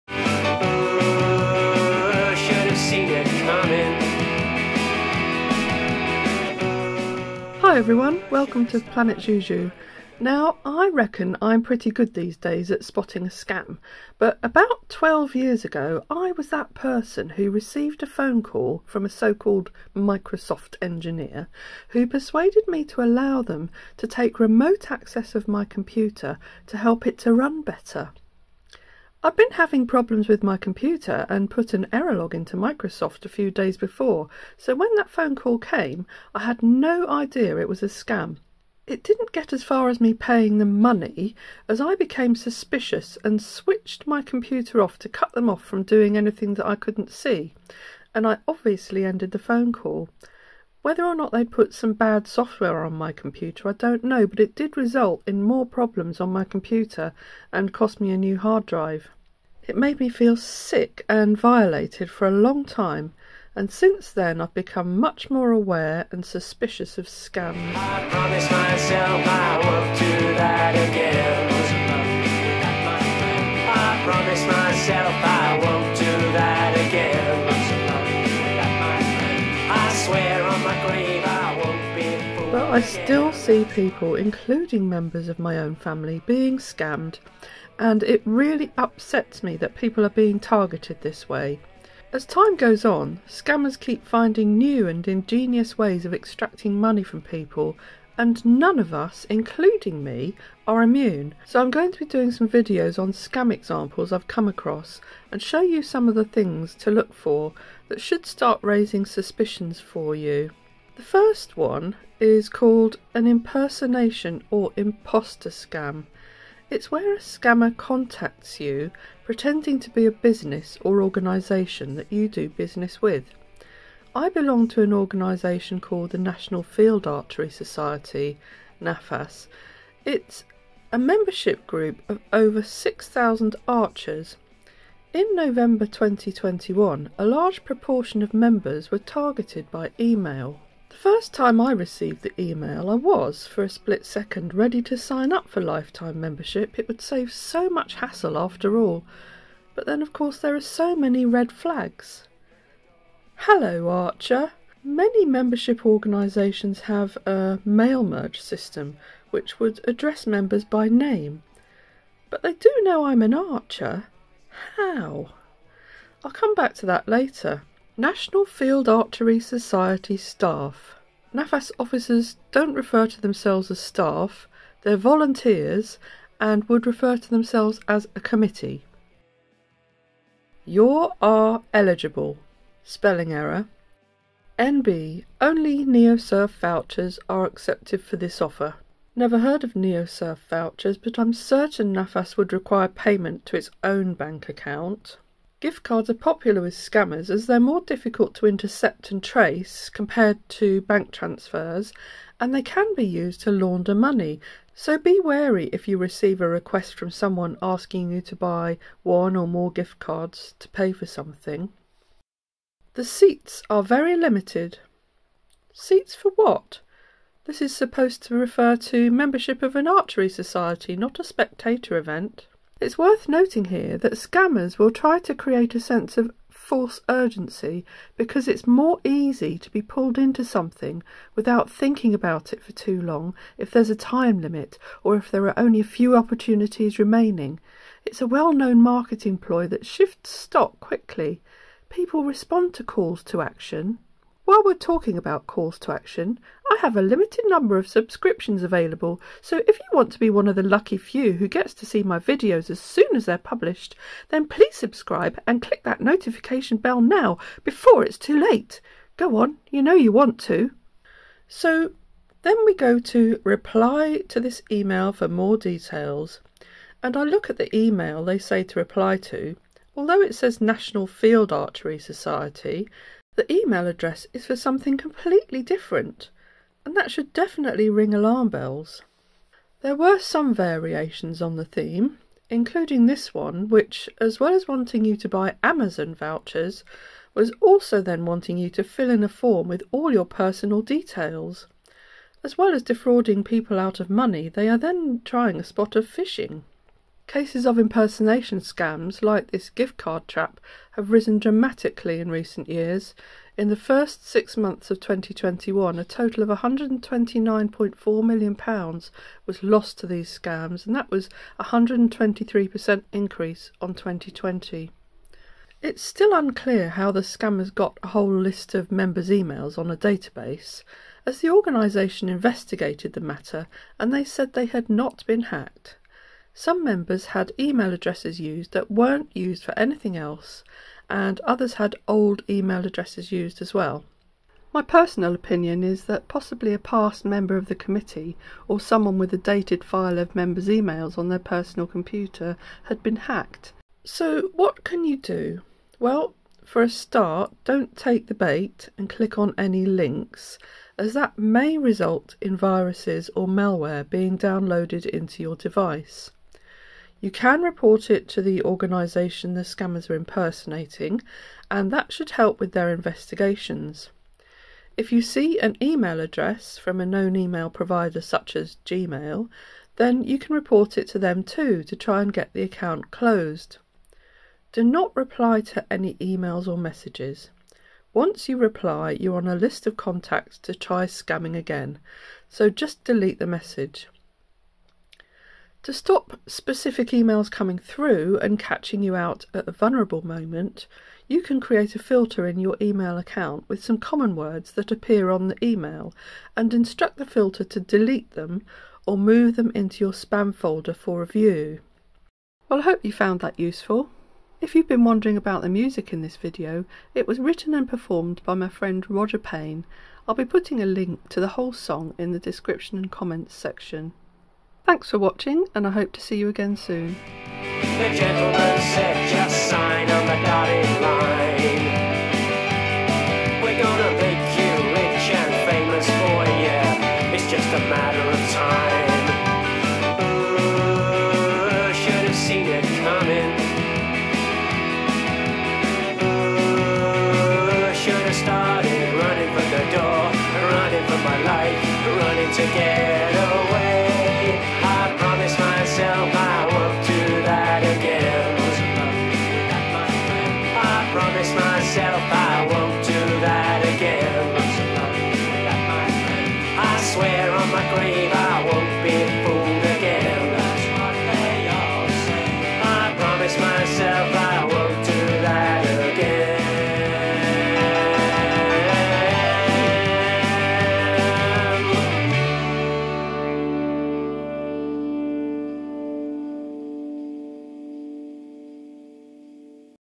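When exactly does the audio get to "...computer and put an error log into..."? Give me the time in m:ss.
0:30.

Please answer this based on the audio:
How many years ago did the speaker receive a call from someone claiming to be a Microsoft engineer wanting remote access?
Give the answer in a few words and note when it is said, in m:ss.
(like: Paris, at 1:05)
12, at 0:14.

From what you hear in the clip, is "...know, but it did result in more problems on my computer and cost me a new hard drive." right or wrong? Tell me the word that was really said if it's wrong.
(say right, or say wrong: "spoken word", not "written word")
right.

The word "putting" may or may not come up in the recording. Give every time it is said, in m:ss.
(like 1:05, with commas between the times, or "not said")
6:50.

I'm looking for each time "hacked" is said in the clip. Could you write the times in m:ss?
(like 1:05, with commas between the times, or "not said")
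5:25, 5:43.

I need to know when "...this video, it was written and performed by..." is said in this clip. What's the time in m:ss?
6:46.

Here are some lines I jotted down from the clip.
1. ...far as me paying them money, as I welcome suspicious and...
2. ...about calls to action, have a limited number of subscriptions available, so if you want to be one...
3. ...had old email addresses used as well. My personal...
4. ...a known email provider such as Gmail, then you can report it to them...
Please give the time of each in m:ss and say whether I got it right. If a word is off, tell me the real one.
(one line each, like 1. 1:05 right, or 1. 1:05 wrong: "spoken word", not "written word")
1. 0:39 wrong: "became", not "welcome"
2. 4:05 right
3. 5:31 right
4. 6:06 right.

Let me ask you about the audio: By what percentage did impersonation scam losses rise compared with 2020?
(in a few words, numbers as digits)
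123%.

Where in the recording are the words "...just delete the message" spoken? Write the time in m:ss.
6:22.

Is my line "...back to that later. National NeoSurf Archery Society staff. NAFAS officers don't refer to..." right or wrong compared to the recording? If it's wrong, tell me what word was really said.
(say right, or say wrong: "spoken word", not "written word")
wrong: "Field", not "NeoSurf".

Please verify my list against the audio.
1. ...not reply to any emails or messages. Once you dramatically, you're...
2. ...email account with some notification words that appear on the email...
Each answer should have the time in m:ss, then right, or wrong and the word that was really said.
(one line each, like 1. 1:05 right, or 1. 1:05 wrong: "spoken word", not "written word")
1. 6:14 wrong: "reply", not "dramatically"
2. 6:32 wrong: "common", not "notification".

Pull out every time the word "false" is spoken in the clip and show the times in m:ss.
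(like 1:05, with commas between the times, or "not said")
3:46.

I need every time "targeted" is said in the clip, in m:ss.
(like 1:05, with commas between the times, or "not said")
1:30, 2:18.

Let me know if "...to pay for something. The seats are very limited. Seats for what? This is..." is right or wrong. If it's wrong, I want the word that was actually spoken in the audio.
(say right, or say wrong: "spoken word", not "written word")
right.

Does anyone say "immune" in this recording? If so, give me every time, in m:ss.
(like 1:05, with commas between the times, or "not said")
1:40.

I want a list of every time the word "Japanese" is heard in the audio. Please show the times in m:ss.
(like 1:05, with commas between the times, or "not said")
not said.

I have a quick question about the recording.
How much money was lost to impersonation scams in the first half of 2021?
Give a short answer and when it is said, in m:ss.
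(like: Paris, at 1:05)
£129.4 million, at 5:06.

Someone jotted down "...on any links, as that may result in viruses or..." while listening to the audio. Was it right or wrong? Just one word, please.
right.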